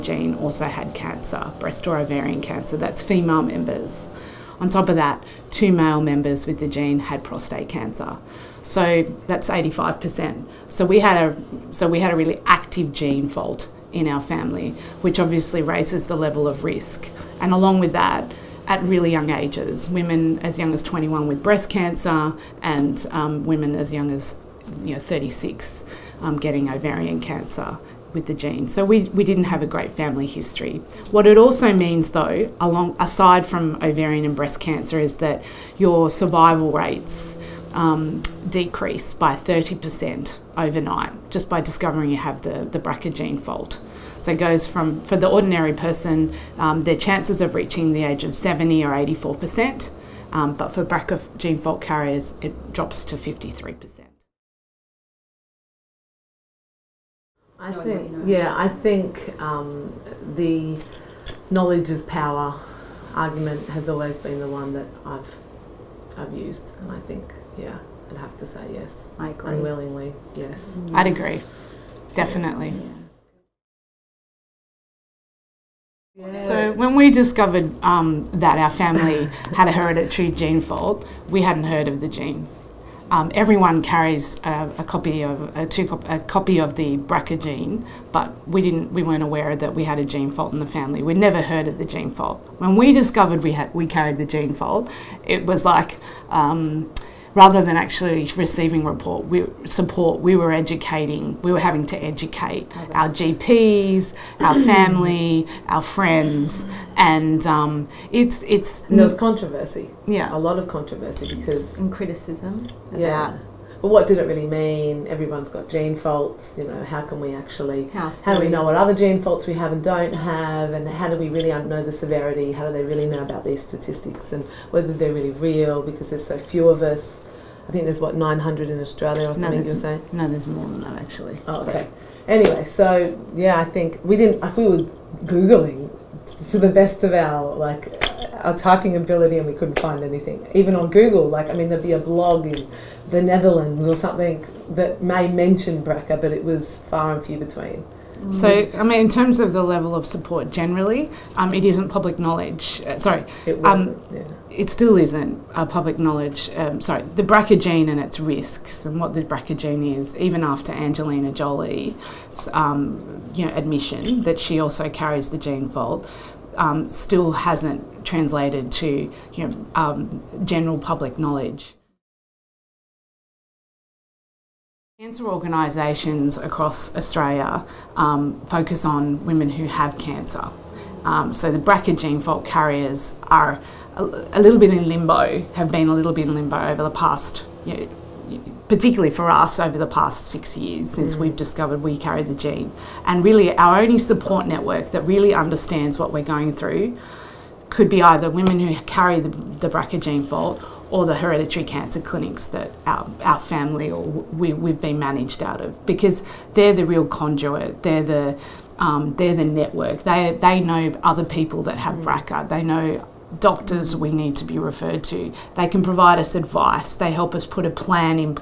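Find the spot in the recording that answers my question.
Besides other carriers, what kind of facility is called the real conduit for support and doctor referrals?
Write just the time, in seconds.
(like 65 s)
201 s.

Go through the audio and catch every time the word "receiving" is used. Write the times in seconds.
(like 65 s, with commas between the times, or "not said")
98 s.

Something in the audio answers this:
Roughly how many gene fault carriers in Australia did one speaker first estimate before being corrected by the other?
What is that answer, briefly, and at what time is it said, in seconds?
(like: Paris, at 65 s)
900, at 128 s.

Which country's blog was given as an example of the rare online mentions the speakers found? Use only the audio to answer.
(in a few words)
the Netherlands.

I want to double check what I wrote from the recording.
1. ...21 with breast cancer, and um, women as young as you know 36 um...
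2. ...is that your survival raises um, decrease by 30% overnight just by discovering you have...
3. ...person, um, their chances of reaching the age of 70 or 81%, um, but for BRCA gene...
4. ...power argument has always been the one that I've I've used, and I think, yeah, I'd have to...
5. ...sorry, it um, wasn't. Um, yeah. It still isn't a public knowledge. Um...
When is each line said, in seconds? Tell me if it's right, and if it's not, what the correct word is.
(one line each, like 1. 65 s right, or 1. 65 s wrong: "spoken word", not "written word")
1. 20 s right
2. 34 s wrong: "rates", not "raises"
3. 45 s wrong: "84", not "81"
4. 62 s right
5. 152 s right.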